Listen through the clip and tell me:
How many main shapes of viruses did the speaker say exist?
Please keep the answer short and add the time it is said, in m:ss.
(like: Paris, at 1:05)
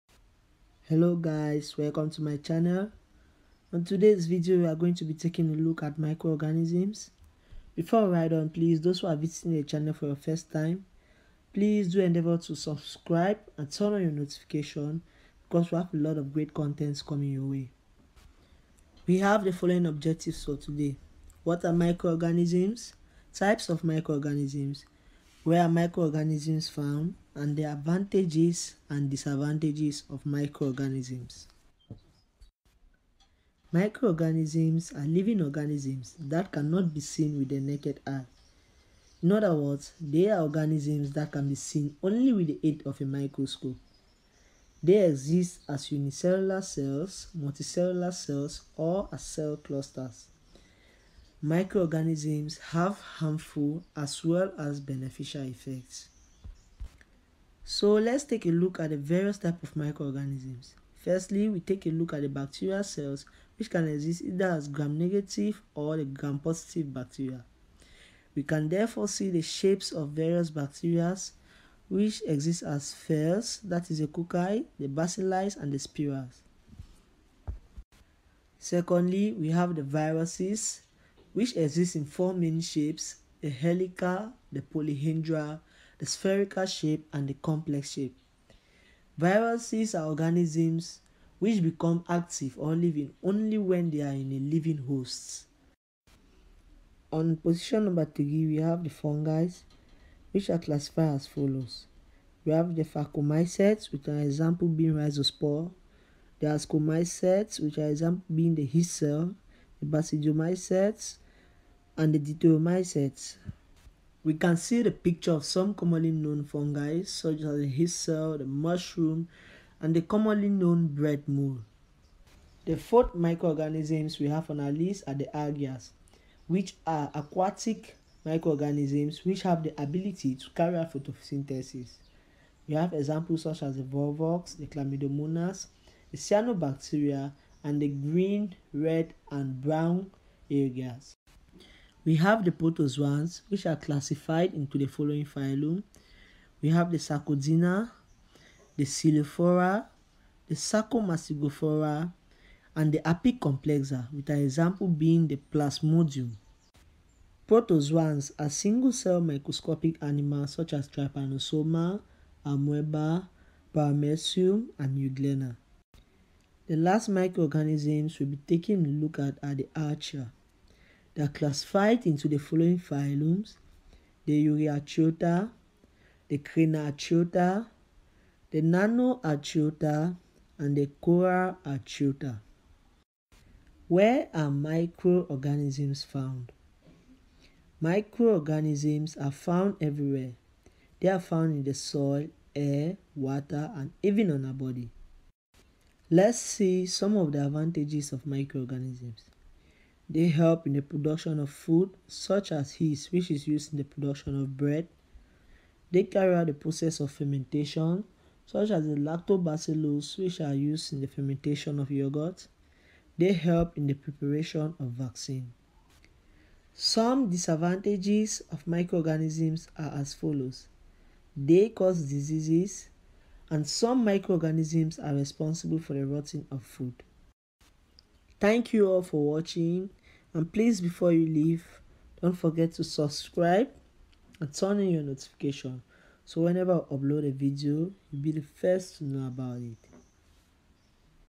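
4, at 1:22.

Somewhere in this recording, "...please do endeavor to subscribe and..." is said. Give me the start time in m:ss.
0:11.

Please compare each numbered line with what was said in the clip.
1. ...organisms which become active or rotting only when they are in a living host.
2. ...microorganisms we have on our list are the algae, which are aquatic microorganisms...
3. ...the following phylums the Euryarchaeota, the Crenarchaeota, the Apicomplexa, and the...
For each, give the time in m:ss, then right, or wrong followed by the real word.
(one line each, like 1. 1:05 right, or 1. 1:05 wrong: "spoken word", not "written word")
1. 1:30 wrong: "living", not "rotting"
2. 2:03 right
3. 2:52 wrong: "Nanoarchaeota", not "Apicomplexa".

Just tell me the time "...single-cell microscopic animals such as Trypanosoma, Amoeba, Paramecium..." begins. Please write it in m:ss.
2:38.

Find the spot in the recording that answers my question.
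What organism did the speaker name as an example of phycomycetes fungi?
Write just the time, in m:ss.
1:44.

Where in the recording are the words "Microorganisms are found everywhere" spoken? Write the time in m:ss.
3:07.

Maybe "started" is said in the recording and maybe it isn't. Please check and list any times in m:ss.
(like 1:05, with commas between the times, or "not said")
not said.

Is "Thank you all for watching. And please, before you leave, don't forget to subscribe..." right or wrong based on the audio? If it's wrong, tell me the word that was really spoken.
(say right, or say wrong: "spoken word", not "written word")
right.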